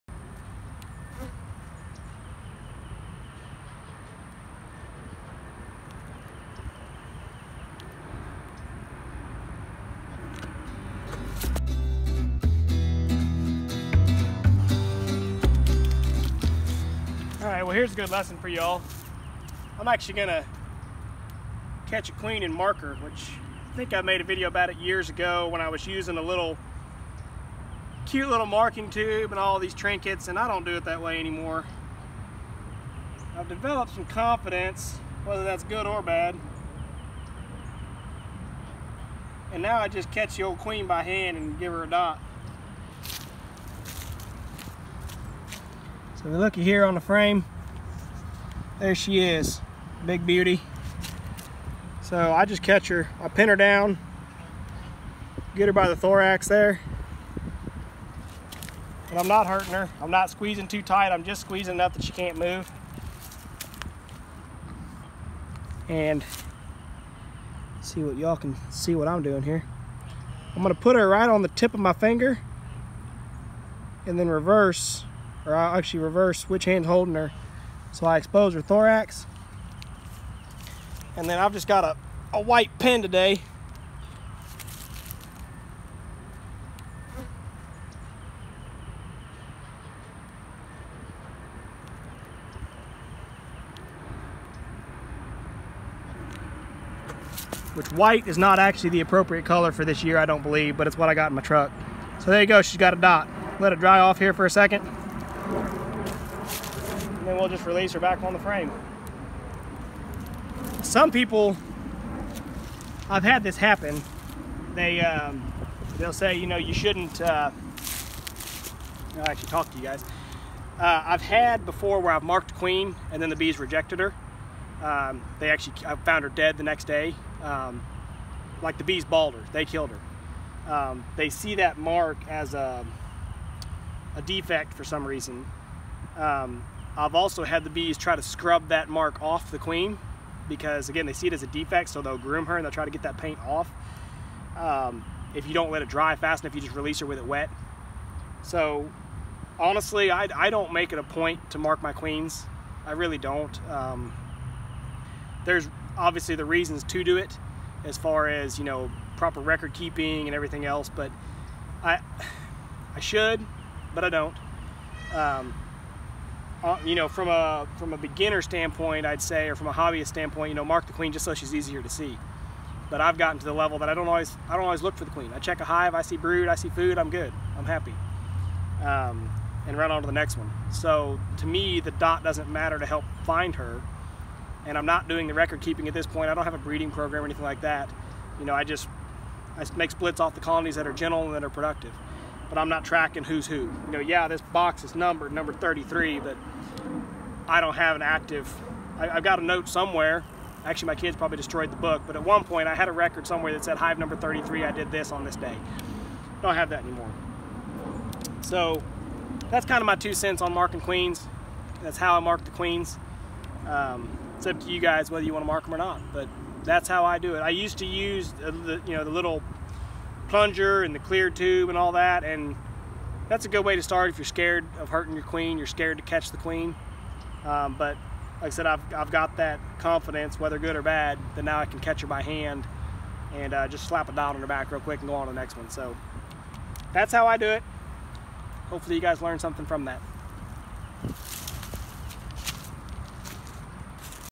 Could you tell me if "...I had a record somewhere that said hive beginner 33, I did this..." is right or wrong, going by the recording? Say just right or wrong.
wrong.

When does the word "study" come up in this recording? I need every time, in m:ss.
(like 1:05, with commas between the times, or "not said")
not said.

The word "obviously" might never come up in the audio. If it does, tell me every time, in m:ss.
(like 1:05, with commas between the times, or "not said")
2:35.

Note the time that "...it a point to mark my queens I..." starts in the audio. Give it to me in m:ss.
2:30.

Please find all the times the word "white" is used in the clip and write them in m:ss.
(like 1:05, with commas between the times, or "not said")
1:22, 1:37.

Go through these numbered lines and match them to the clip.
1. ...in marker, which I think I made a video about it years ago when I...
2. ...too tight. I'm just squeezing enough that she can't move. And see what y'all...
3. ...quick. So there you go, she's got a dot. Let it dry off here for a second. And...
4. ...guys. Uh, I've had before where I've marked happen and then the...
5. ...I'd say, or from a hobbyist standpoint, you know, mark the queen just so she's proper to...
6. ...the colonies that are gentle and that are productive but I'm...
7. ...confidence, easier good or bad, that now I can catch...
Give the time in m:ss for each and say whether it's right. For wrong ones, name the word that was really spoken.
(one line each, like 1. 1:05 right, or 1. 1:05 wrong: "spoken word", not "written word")
1. 0:22 right
2. 1:00 right
3. 1:41 wrong: "truck", not "quick"
4. 1:59 wrong: "queen", not "happen"
5. 2:49 wrong: "easier", not "proper"
6. 3:10 right
7. 3:49 wrong: "whether", not "easier".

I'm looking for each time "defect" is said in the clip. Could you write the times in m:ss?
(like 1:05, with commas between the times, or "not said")
2:14, 2:21.